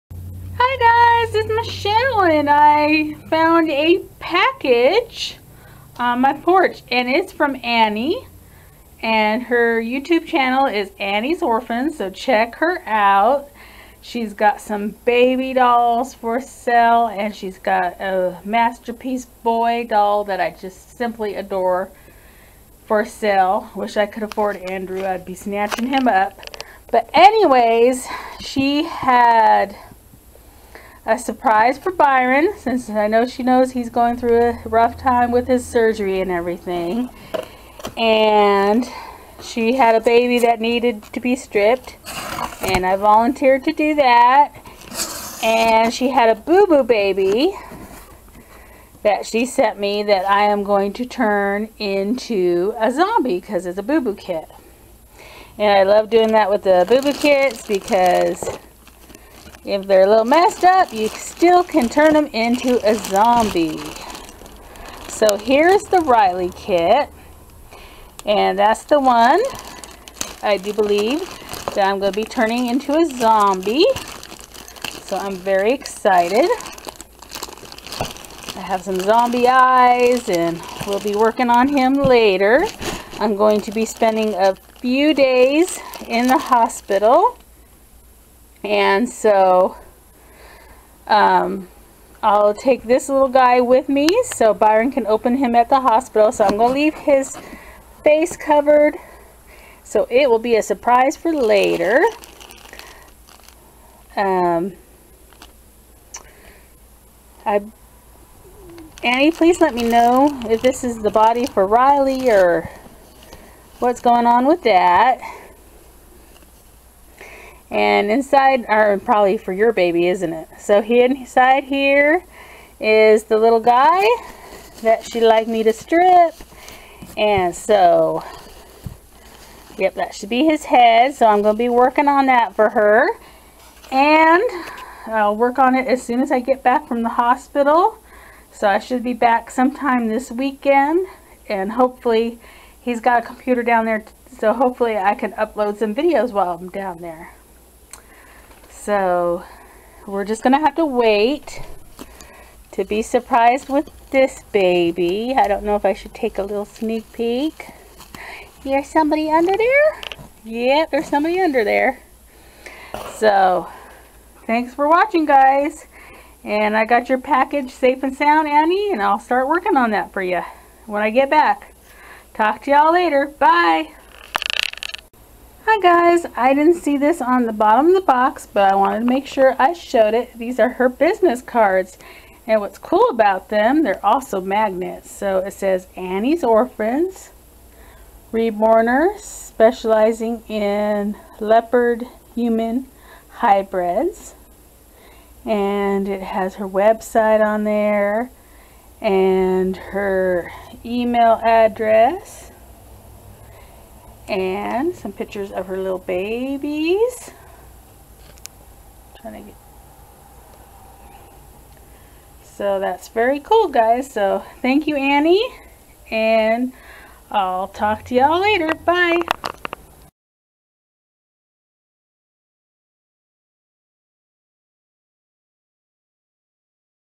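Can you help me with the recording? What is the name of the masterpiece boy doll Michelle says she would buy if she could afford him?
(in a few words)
Andrew.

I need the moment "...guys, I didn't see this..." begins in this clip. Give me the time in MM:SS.
02:55.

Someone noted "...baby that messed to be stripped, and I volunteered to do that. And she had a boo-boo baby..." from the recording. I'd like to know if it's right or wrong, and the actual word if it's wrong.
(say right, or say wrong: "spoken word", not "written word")
wrong: "needed", not "messed".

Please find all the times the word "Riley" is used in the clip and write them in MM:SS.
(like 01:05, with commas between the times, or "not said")
01:05, 01:51.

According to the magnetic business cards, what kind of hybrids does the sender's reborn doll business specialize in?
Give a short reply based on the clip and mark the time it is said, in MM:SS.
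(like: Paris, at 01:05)
Leopard human hybrids, at 03:11.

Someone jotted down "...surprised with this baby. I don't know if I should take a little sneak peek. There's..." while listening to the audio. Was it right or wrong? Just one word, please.
right.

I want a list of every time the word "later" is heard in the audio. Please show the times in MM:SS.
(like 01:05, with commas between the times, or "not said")
01:21, 01:41, 02:52, 03:38.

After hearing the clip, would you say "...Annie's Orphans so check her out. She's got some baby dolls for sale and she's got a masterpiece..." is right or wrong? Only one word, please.
right.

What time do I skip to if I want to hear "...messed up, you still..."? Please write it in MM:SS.
01:00.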